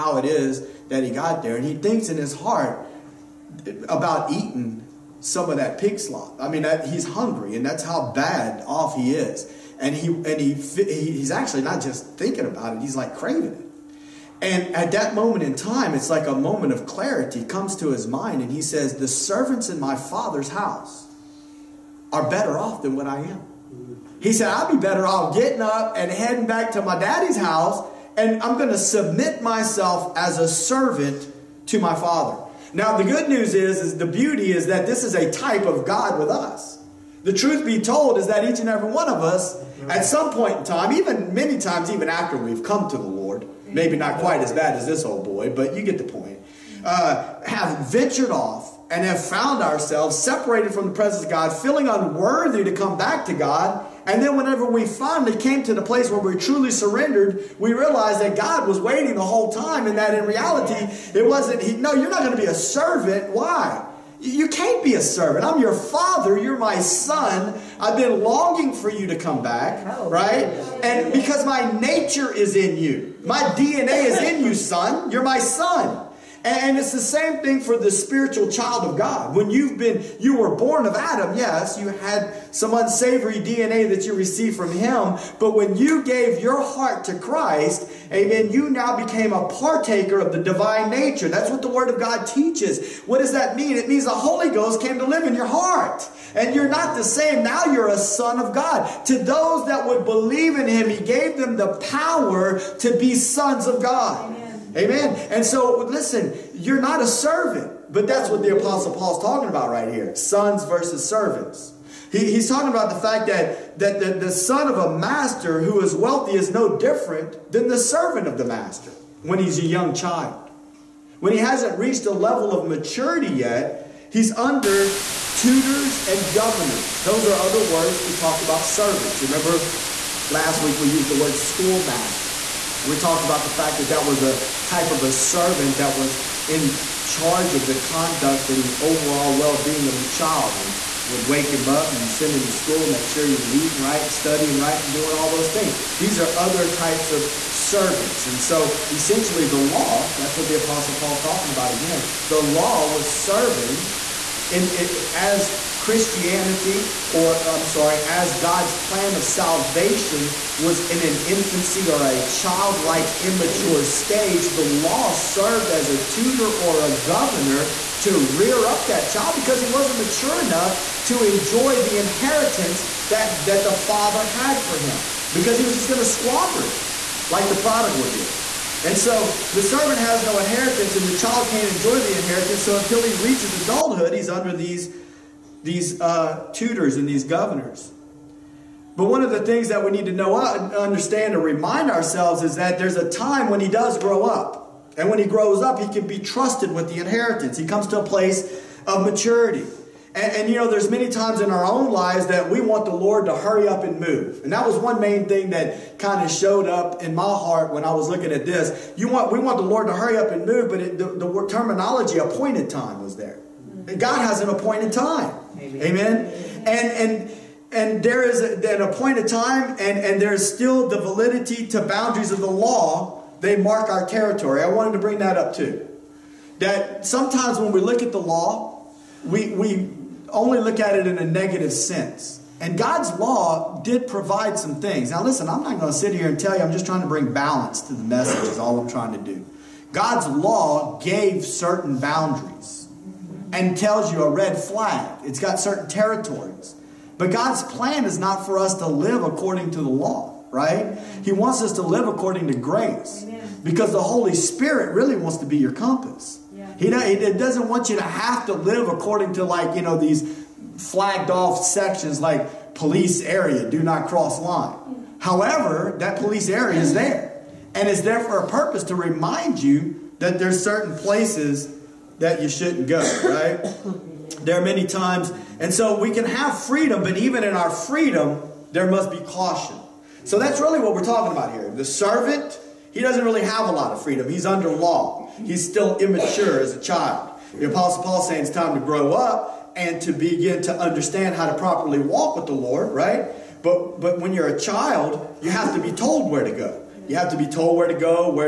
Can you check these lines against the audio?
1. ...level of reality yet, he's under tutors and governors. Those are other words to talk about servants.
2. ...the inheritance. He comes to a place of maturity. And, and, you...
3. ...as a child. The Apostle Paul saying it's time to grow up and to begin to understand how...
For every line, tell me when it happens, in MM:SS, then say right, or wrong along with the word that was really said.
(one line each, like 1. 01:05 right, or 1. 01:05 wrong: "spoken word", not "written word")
1. 02:02 wrong: "maturity", not "reality"
2. 03:16 right
3. 04:46 right.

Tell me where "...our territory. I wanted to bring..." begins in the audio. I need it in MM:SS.
03:43.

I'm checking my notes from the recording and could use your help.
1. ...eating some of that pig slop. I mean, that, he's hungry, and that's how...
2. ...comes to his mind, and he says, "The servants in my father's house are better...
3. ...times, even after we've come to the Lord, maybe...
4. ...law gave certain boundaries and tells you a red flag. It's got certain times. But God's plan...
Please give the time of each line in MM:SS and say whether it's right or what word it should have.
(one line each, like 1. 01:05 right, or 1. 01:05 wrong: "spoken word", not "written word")
1. 00:04 right
2. 00:17 right
3. 00:41 right
4. 04:00 wrong: "territories", not "times".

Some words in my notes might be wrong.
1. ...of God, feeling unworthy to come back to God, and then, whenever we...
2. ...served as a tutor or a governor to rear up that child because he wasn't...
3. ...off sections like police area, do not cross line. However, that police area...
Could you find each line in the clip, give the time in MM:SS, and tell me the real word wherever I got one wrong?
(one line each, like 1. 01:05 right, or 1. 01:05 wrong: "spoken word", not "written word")
1. 00:51 right
2. 02:45 right
3. 04:21 right.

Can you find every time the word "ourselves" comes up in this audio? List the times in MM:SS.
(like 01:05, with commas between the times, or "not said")
00:49, 03:11.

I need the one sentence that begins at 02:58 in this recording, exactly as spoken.
And so the servant has no inheritance, and the child can't enjoy the inheritance.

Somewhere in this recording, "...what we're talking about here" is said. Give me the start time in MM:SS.
04:40.